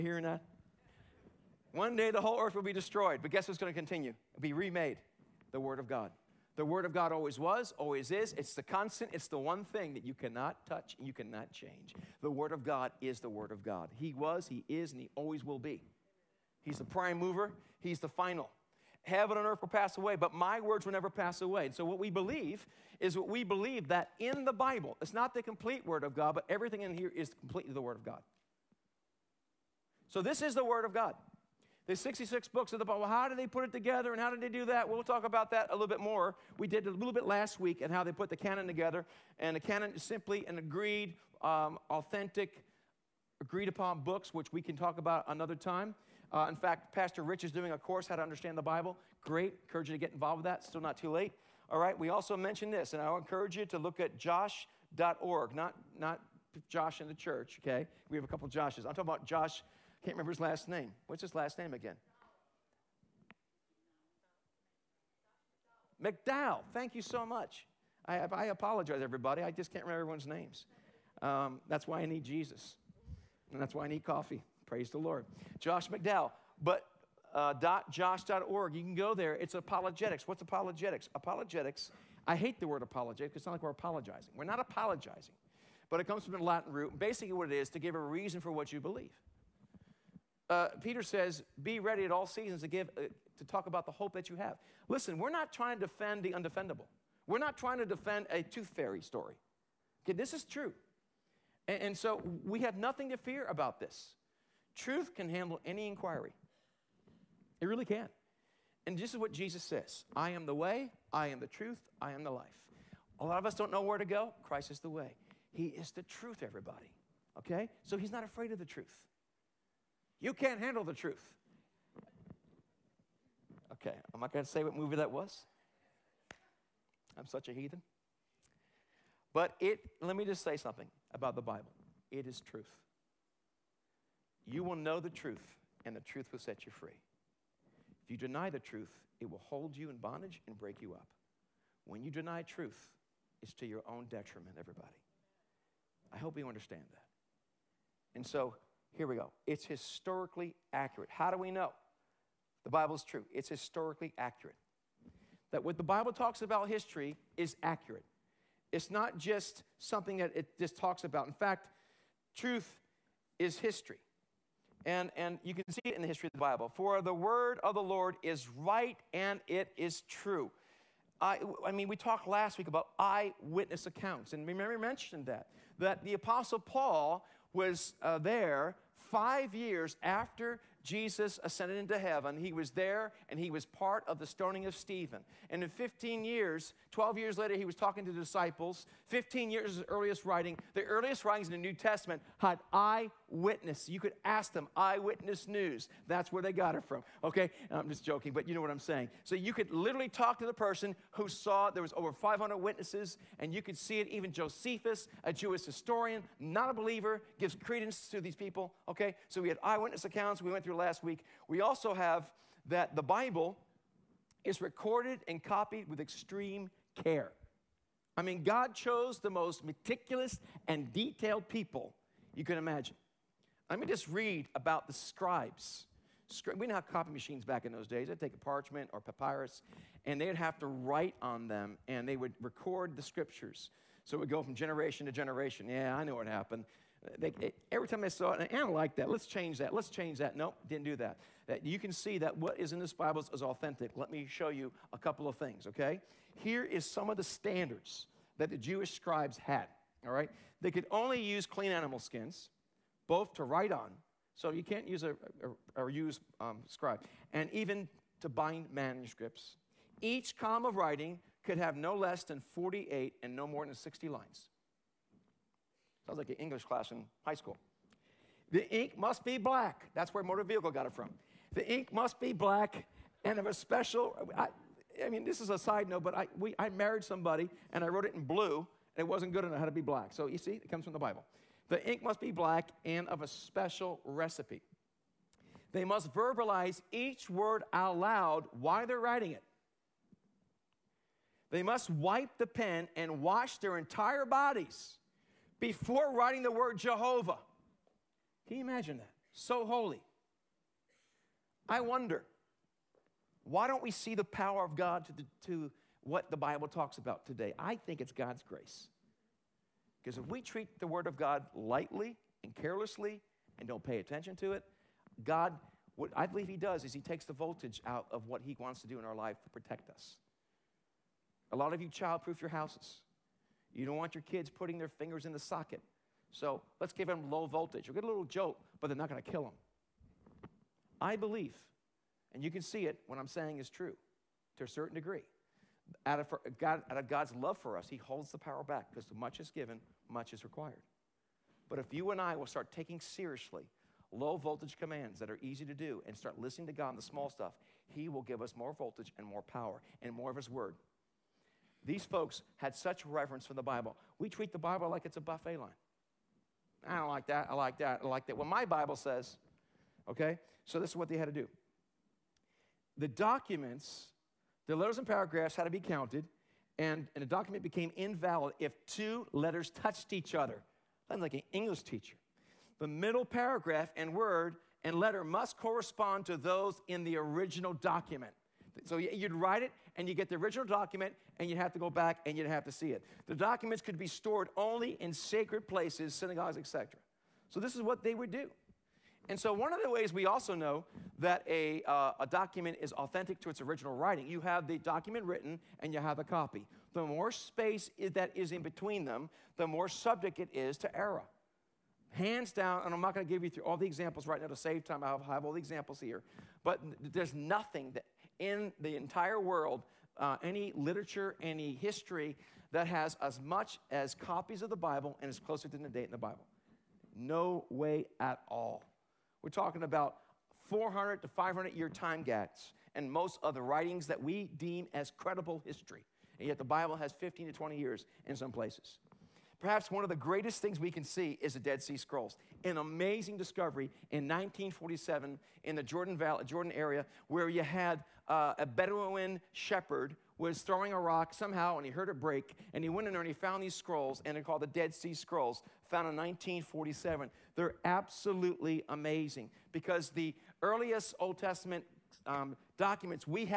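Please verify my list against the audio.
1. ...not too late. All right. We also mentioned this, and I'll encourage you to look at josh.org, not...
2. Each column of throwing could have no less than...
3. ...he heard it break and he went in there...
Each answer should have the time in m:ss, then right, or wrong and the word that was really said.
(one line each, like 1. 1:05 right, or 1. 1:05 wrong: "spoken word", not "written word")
1. 0:50 right
2. 4:20 wrong: "writing", not "throwing"
3. 7:21 right.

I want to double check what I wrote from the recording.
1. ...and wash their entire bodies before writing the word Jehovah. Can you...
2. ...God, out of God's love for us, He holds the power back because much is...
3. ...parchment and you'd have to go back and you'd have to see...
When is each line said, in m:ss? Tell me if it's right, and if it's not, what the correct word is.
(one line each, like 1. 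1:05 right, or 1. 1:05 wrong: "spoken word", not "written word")
1. 4:52 right
2. 5:36 right
3. 6:20 wrong: "document", not "parchment".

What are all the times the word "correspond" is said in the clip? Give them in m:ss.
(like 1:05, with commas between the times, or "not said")
6:15.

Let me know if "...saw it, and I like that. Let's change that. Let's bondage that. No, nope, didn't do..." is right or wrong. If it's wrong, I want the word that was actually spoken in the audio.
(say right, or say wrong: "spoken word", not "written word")
wrong: "change", not "bondage".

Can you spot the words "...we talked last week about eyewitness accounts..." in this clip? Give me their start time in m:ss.
2:51.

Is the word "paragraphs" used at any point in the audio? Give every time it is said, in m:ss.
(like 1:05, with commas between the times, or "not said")
6:05, 6:13.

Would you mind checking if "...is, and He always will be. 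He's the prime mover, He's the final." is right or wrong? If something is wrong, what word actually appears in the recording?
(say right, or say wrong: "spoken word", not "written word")
right.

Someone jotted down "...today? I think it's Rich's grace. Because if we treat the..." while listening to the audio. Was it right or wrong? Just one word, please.
wrong.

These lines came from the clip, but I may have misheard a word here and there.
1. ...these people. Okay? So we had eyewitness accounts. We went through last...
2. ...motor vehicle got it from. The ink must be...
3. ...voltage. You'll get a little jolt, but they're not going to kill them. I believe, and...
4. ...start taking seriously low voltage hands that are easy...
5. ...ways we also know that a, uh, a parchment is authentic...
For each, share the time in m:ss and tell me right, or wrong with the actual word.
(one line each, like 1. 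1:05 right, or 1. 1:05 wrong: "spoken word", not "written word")
1. 3:28 right
2. 4:30 right
3. 5:27 right
4. 5:42 wrong: "commands", not "hands"
5. 6:29 wrong: "document", not "parchment".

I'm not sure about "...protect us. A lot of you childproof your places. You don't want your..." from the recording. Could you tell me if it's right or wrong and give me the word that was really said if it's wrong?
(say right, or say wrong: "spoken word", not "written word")
wrong: "houses", not "places".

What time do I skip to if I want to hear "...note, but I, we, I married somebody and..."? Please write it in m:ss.
4:35.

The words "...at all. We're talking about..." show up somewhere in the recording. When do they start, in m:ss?
6:58.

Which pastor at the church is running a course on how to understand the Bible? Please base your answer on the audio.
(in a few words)
Pastor Rich.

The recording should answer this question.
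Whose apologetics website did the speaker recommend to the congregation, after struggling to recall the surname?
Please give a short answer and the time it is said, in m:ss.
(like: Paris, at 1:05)
Josh McDowell, at 1:15.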